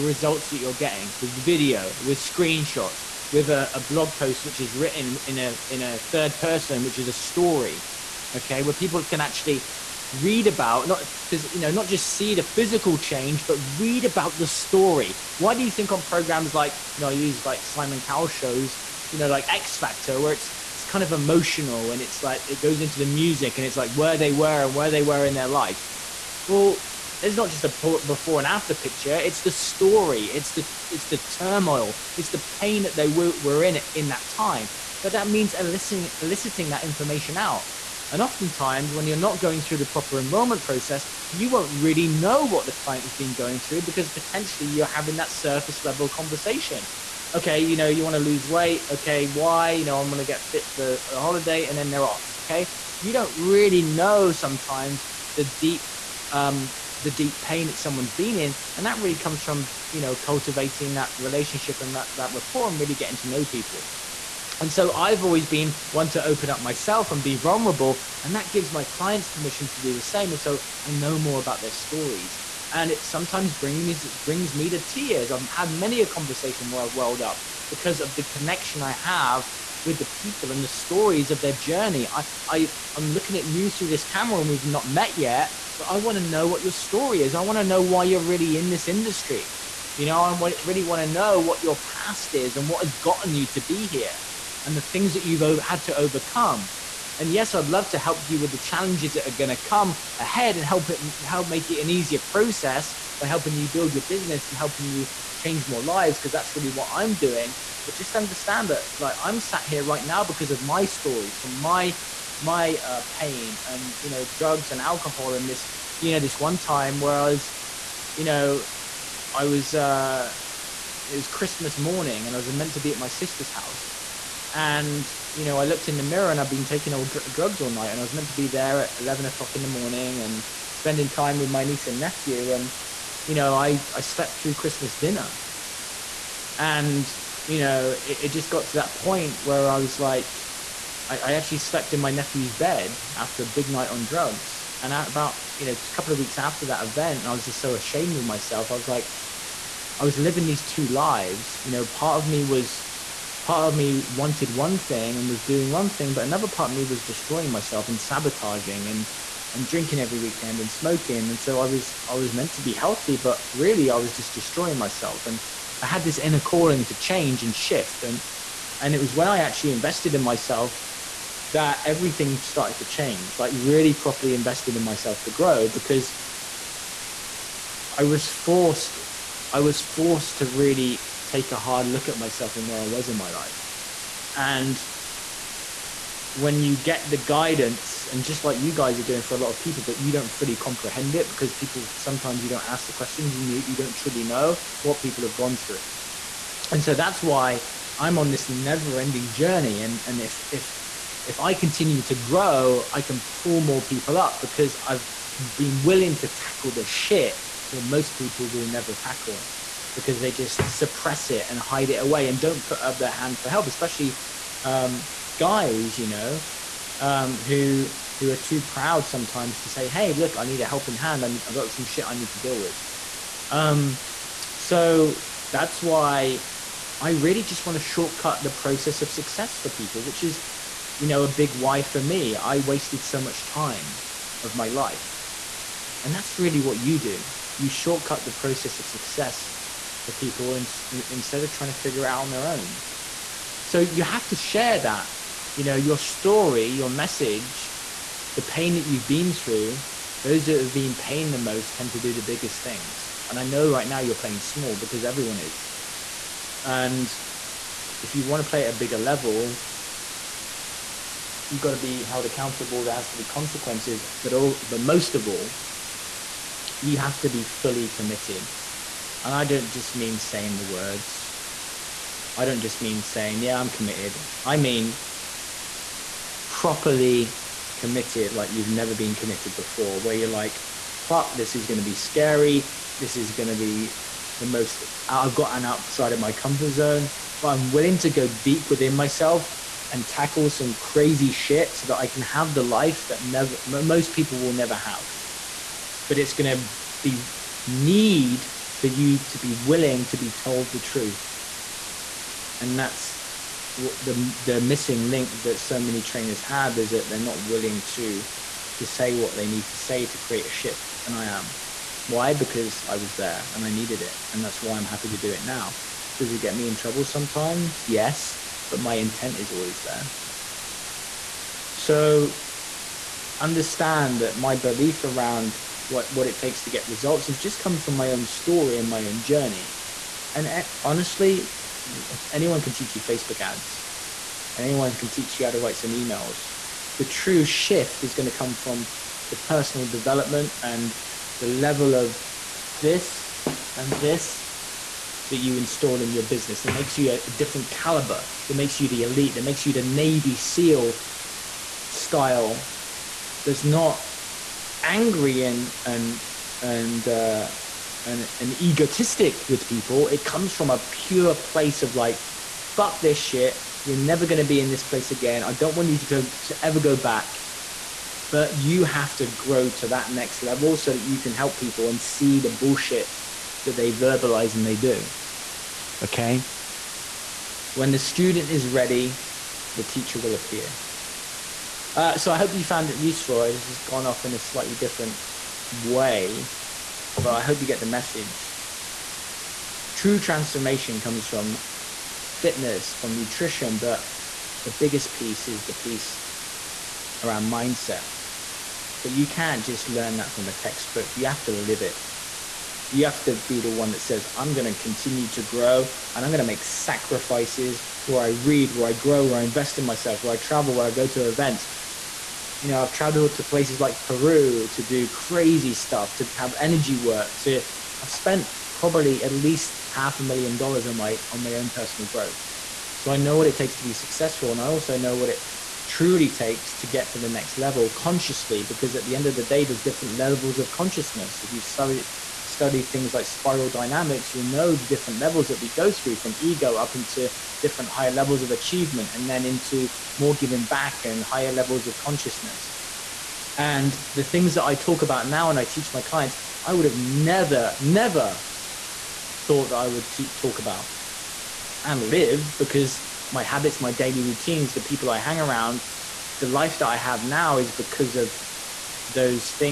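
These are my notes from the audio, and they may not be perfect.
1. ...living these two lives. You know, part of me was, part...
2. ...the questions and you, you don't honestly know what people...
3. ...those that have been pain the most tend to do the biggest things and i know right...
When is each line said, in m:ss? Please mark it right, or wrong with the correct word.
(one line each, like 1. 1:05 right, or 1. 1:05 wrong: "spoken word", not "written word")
1. 2:30 right
2. 3:12 wrong: "truly", not "honestly"
3. 4:10 right.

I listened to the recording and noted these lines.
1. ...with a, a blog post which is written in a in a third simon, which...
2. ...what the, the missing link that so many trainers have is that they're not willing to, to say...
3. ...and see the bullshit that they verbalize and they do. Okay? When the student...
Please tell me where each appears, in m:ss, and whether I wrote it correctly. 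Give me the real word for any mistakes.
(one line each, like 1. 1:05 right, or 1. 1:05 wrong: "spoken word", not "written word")
1. 0:03 wrong: "person", not "simon"
2. 5:03 right
3. 6:11 right.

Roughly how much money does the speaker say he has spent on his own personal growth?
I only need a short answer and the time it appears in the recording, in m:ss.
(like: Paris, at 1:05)
half a million dollars, at 6:59.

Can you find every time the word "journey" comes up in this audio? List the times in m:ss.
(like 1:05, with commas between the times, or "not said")
1:21, 3:19, 5:29.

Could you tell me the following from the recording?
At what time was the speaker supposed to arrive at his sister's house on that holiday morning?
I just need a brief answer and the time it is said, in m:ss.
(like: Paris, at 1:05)
11 o'clock, at 2:08.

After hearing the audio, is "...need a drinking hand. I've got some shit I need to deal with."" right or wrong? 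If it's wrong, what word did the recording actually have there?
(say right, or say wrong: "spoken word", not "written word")
wrong: "helping", not "drinking".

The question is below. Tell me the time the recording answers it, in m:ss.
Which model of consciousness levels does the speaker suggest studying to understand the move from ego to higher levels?
7:13.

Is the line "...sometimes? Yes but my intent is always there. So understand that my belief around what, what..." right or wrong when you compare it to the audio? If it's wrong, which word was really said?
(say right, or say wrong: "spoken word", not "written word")
right.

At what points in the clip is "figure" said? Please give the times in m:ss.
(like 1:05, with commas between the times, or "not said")
4:01.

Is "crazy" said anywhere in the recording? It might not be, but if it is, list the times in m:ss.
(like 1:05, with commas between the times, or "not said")
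4:50, 6:55.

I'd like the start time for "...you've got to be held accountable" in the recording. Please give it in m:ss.
4:21.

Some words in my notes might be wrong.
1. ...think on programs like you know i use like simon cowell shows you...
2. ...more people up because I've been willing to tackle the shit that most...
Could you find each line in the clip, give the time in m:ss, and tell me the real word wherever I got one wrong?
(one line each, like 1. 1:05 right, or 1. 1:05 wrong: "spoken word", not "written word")
1. 0:15 right
2. 3:23 right.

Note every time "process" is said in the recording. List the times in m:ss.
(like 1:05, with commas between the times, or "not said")
0:40, 1:42, 3:48, 3:58.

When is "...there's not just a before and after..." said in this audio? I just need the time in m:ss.
0:27.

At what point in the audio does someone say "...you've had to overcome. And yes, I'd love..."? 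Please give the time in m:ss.
1:35.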